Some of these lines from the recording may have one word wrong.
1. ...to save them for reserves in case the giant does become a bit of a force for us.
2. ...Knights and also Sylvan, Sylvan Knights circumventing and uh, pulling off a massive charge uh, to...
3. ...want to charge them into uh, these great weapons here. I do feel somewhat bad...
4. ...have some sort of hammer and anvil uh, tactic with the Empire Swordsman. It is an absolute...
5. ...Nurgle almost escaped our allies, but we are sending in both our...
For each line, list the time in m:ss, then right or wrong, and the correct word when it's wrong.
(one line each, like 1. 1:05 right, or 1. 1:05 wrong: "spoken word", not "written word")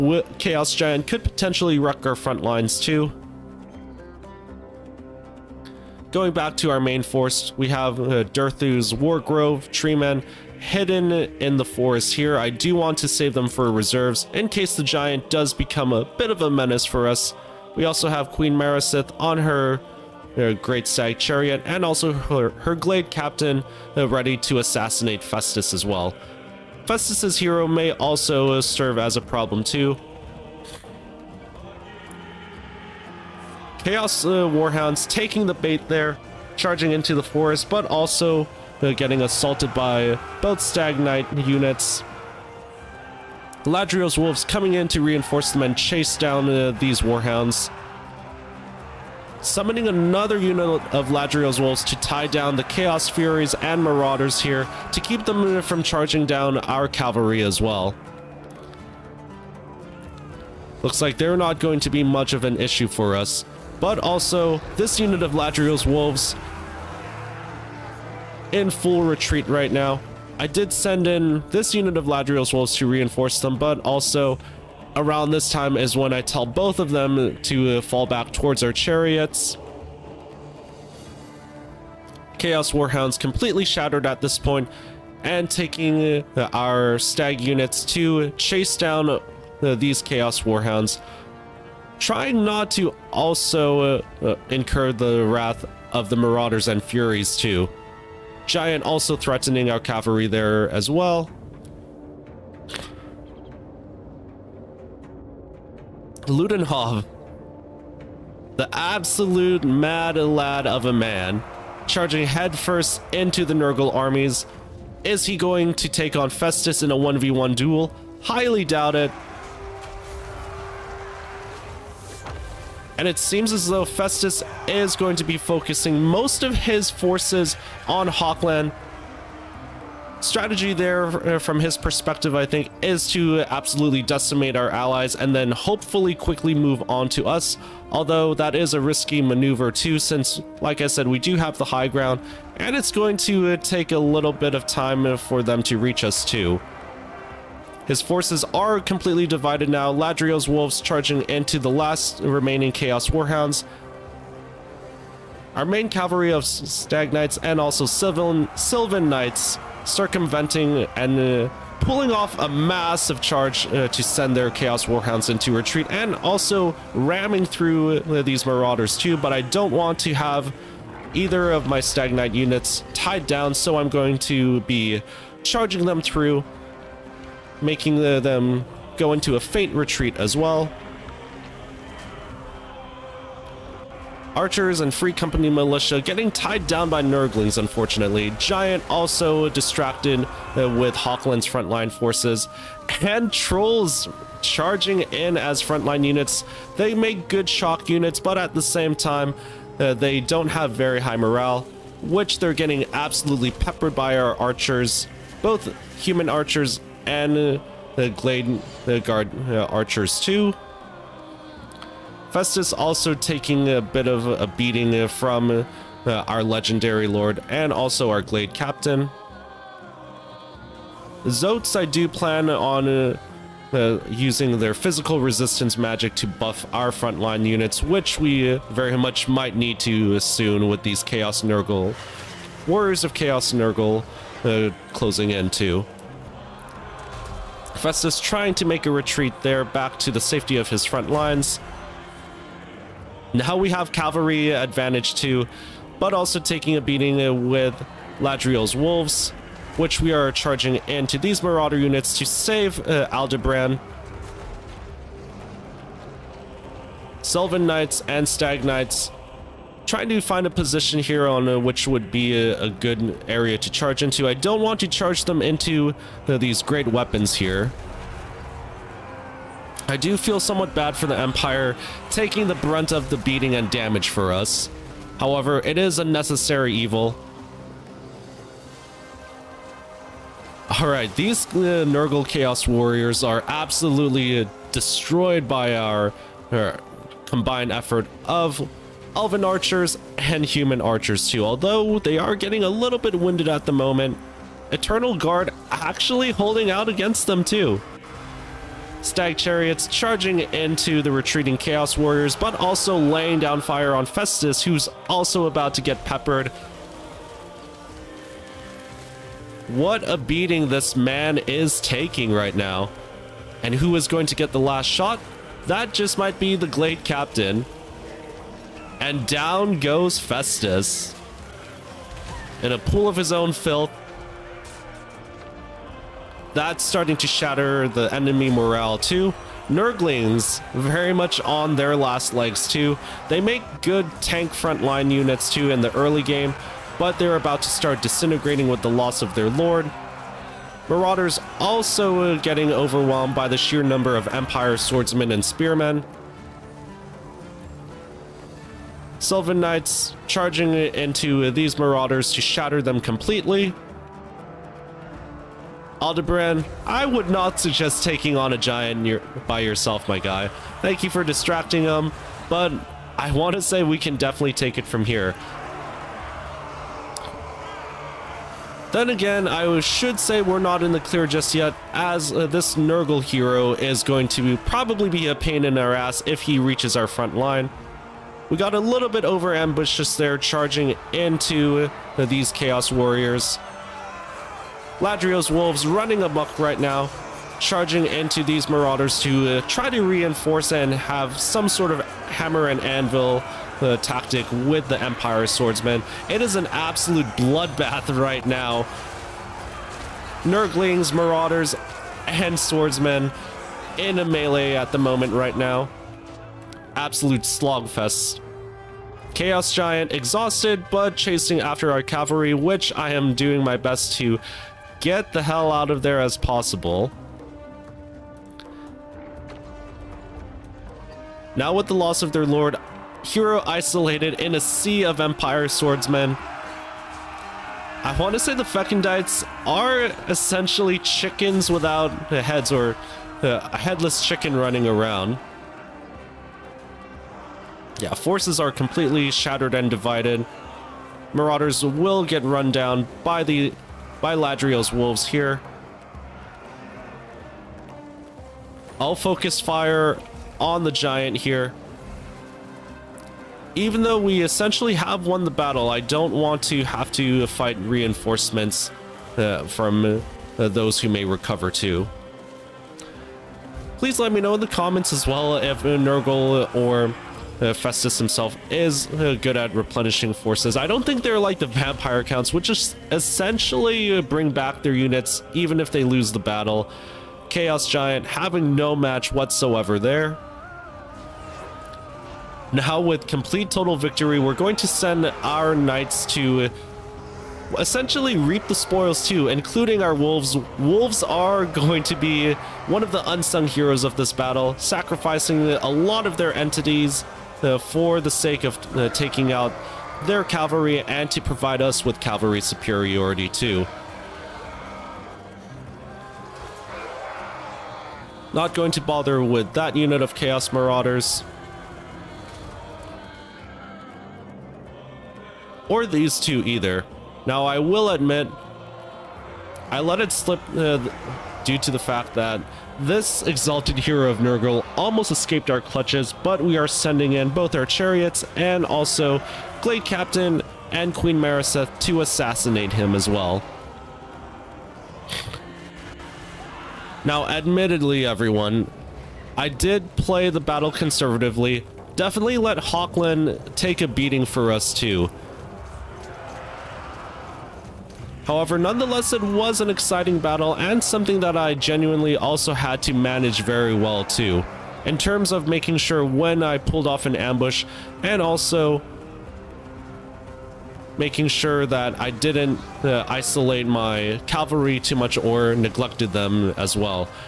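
1. 0:12 wrong: "menace", not "force"
2. 2:37 right
3. 4:24 right
4. 6:30 right
5. 8:44 wrong: "clutches", not "allies".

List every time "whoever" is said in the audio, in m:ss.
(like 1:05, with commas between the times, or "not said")
not said.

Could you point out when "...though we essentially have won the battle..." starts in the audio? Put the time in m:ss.
7:34.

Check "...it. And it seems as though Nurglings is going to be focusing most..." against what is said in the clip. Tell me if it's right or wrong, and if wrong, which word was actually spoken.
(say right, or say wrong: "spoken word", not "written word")
wrong: "Festus", not "Nurglings".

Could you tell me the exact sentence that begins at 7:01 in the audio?
Now with the loss of their lord, hero isolated in a sea of Empire swordsmen.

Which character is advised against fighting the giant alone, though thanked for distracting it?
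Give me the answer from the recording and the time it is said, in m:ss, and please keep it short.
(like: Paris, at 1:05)
Aldebaran, at 5:56.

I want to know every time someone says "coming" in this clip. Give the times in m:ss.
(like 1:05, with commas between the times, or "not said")
0:44.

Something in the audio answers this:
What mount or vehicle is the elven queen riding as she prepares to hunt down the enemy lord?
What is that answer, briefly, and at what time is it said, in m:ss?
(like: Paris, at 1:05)
Great Stag Chariot, at 0:20.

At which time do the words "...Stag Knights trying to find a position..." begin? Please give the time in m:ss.
4:18.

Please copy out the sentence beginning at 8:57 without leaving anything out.
Now, admittedly, everyone, I did play the battle conservatively.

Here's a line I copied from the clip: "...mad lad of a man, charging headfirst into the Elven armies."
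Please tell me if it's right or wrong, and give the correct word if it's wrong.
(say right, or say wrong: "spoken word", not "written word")
wrong: "Nurgle", not "Elven".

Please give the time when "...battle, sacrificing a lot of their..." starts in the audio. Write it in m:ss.
8:14.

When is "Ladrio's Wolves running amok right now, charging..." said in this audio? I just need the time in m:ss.
6:24.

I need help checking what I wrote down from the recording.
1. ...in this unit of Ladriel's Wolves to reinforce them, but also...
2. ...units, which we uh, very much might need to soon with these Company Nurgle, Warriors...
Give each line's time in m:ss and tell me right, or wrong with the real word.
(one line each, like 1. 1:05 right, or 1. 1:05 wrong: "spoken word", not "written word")
1. 1:11 right
2. 3:47 wrong: "Chaos", not "Company".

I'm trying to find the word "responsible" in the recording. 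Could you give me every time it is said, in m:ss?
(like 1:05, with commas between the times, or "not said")
not said.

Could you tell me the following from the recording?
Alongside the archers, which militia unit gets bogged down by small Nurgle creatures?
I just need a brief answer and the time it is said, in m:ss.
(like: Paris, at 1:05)
Free Company Militia, at 3:04.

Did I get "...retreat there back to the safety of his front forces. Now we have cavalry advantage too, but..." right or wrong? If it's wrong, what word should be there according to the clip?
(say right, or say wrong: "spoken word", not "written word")
wrong: "lines", not "forces".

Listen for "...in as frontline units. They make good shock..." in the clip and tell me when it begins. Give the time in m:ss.
3:15.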